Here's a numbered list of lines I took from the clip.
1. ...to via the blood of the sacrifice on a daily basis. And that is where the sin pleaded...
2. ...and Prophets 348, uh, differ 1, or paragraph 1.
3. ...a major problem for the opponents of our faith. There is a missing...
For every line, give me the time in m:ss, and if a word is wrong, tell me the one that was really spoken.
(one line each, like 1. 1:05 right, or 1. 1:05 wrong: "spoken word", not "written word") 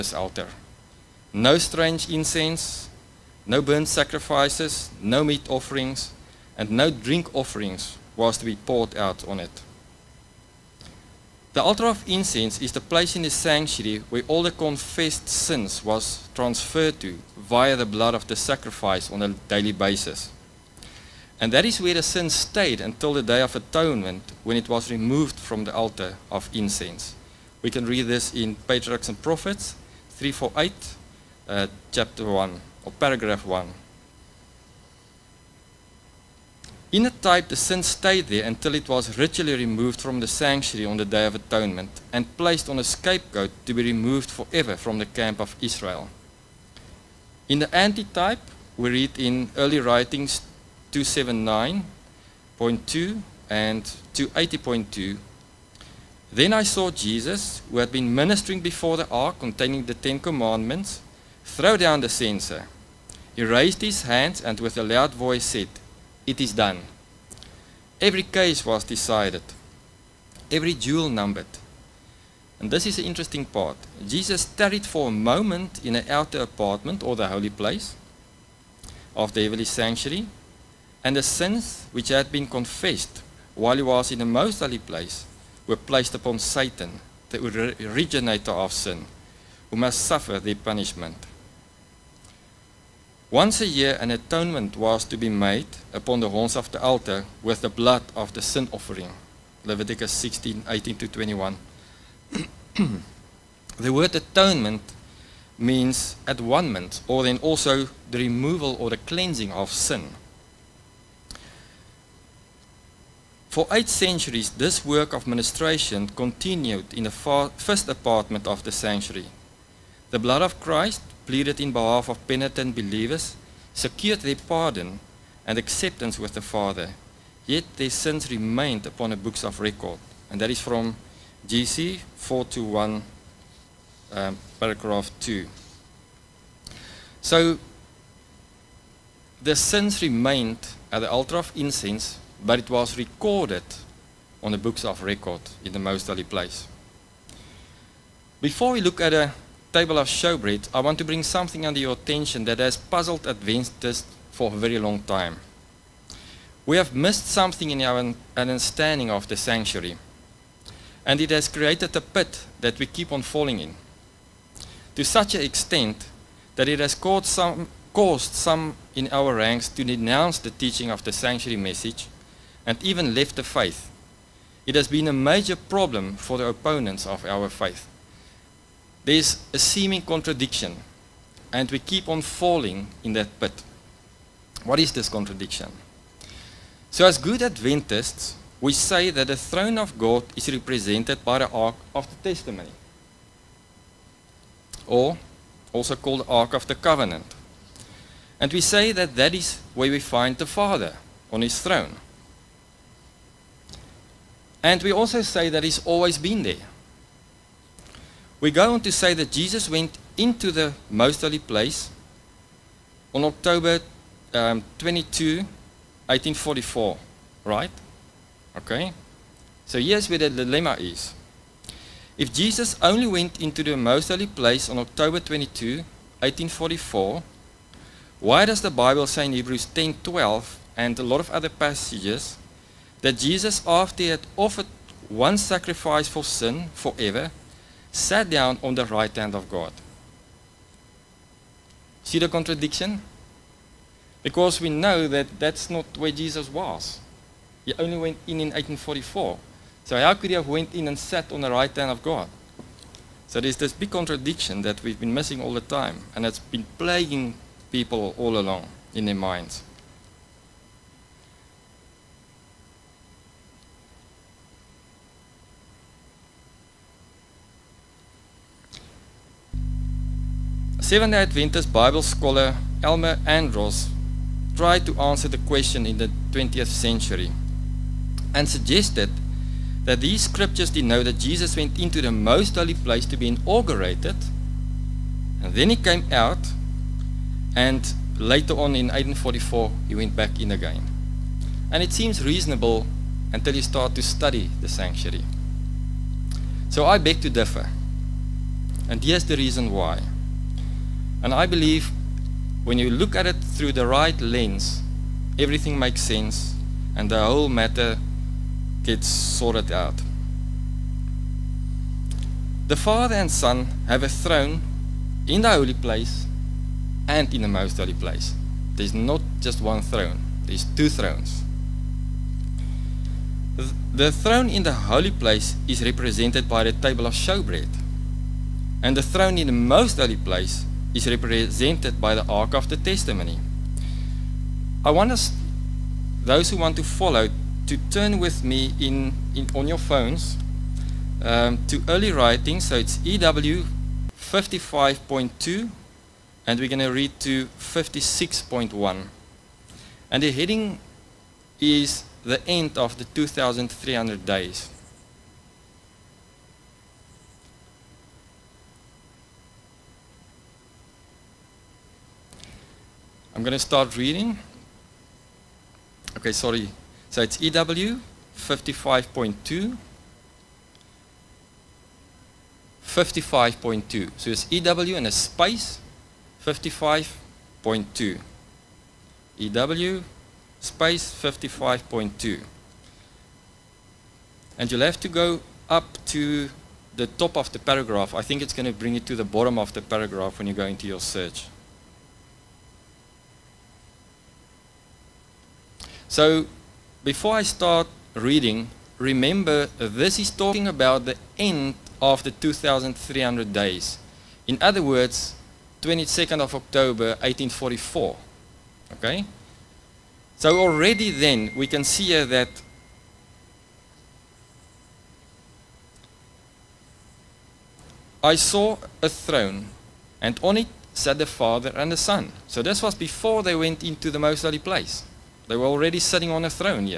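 1. 0:17 wrong: "stayed", not "pleaded"
2. 0:29 wrong: "chapter", not "differ"
3. 2:55 wrong: "seeming", not "missing".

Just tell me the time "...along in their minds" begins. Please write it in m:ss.
4:18.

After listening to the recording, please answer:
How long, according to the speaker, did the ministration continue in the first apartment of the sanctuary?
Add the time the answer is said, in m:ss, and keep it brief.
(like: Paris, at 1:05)
Eight centuries, at 1:53.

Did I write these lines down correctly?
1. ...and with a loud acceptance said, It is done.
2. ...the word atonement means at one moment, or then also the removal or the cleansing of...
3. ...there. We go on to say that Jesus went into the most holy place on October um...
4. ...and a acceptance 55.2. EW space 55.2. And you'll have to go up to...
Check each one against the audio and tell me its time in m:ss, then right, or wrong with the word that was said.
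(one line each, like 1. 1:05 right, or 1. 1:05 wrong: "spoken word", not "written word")
1. 1:04 wrong: "voice", not "acceptance"
2. 1:43 right
3. 3:26 right
4. 6:14 wrong: "space", not "acceptance".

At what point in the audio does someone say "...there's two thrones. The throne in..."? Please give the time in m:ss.
5:20.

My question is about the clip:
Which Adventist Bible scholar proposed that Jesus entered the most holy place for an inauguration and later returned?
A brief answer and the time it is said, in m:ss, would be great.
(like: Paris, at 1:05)
M.L. Andreasen, at 4:32.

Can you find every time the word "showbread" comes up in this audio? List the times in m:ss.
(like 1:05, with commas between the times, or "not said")
2:30, 5:27.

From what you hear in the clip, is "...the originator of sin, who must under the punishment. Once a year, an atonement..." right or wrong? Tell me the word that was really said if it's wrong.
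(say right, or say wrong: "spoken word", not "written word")
wrong: "suffer", not "under".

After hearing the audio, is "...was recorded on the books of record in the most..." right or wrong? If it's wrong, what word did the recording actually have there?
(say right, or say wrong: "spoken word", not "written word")
right.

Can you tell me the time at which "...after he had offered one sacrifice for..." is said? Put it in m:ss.
3:53.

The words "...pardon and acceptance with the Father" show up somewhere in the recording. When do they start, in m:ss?
2:04.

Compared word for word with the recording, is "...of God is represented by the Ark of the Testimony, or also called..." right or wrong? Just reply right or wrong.
right.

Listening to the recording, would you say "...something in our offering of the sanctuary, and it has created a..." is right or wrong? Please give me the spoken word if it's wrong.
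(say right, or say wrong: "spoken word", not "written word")
wrong: "understanding", not "offering".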